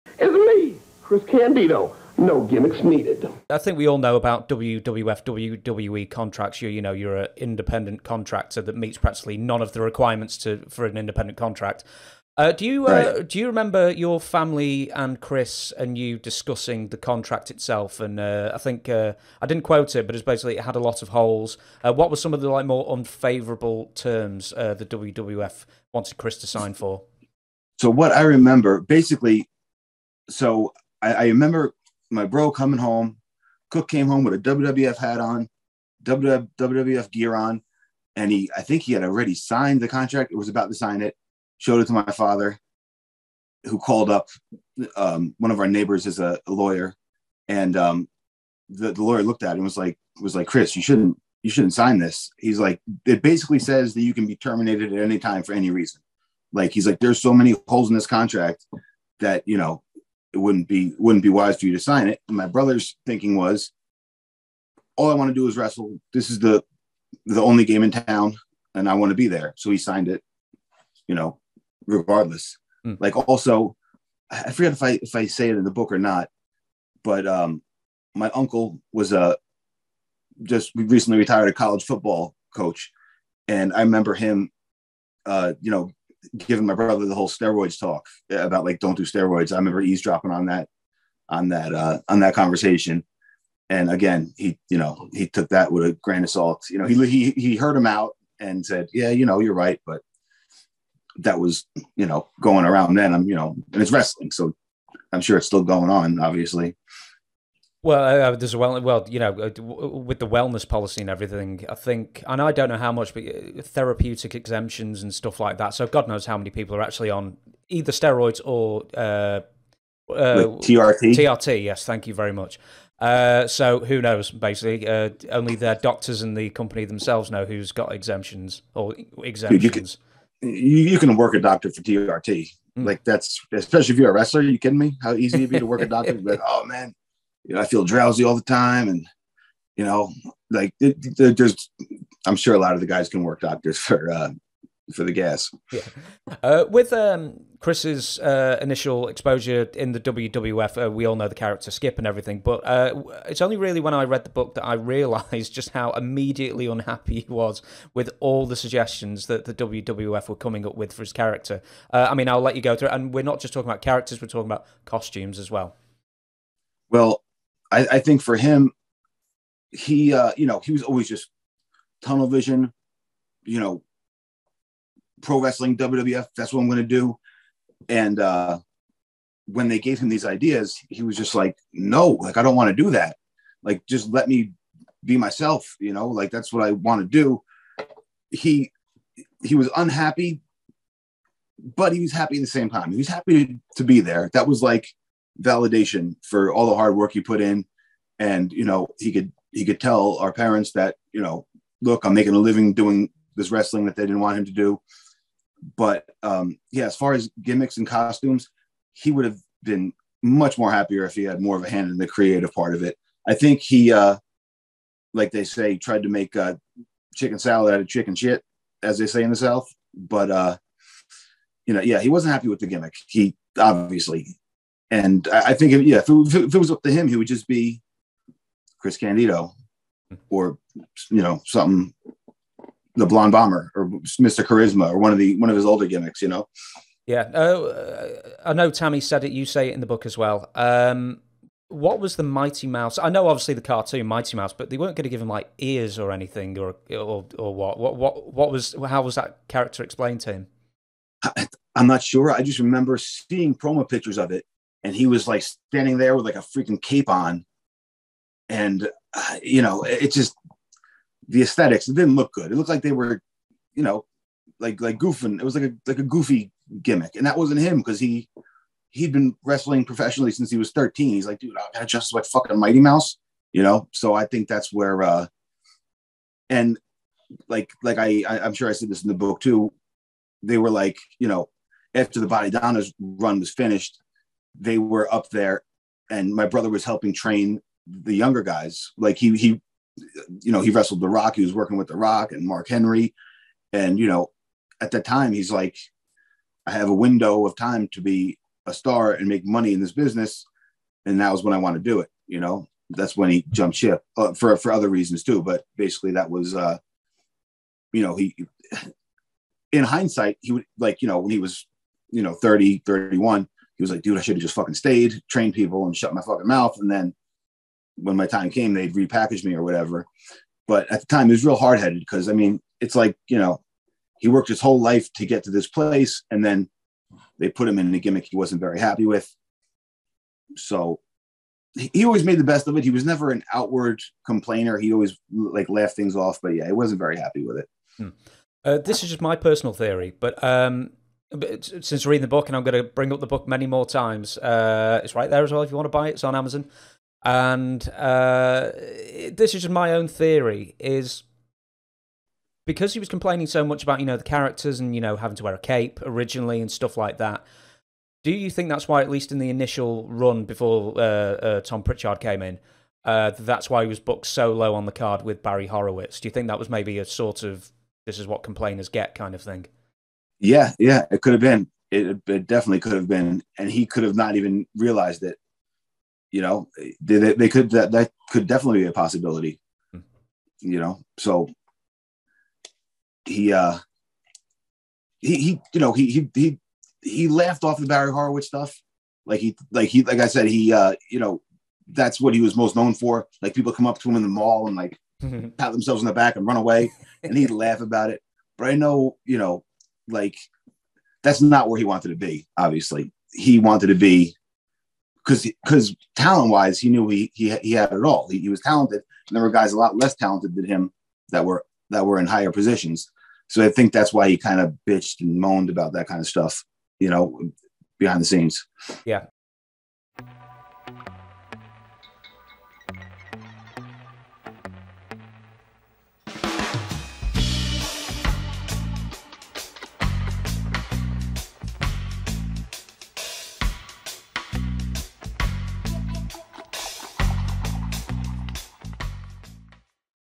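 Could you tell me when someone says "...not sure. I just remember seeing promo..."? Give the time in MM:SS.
04:11.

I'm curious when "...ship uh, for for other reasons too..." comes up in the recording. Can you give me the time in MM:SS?
05:03.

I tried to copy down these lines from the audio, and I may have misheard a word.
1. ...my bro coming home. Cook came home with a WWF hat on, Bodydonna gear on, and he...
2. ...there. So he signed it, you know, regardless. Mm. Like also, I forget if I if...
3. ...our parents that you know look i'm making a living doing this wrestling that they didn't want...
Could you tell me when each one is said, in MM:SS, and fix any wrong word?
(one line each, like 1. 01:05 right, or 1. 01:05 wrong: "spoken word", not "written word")
1. 00:32 wrong: "WWF", not "Bodydonna"
2. 01:09 right
3. 03:20 right.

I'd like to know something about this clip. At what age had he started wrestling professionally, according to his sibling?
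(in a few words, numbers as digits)
13.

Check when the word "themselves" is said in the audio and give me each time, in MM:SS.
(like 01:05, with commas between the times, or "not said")
02:06, 06:35.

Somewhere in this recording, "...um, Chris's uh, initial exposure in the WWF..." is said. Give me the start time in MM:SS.
02:26.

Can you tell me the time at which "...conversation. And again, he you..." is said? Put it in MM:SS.
01:32.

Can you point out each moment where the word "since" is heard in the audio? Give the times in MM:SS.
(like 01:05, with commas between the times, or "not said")
04:30, 05:41.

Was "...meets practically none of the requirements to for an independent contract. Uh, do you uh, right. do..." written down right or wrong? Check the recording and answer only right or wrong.
right.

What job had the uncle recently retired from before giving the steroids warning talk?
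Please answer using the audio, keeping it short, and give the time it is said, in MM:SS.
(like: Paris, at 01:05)
College football coach, at 01:21.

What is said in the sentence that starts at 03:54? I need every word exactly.
Charisma or one of the one of his older gimmicks, you know.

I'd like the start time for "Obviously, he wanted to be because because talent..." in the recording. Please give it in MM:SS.
06:42.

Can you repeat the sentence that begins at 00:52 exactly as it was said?
He's like it basically says that you can be terminated at any time for any reason.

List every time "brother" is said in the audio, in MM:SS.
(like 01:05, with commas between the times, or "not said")
01:02, 01:26, 04:46.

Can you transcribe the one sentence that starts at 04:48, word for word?
Like he he you know, he wrestled The Rock, he was working with The Rock and Mark Henry.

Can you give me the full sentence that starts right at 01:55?
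So God knows how many people are actually on either steroids or uh, uh, TRT.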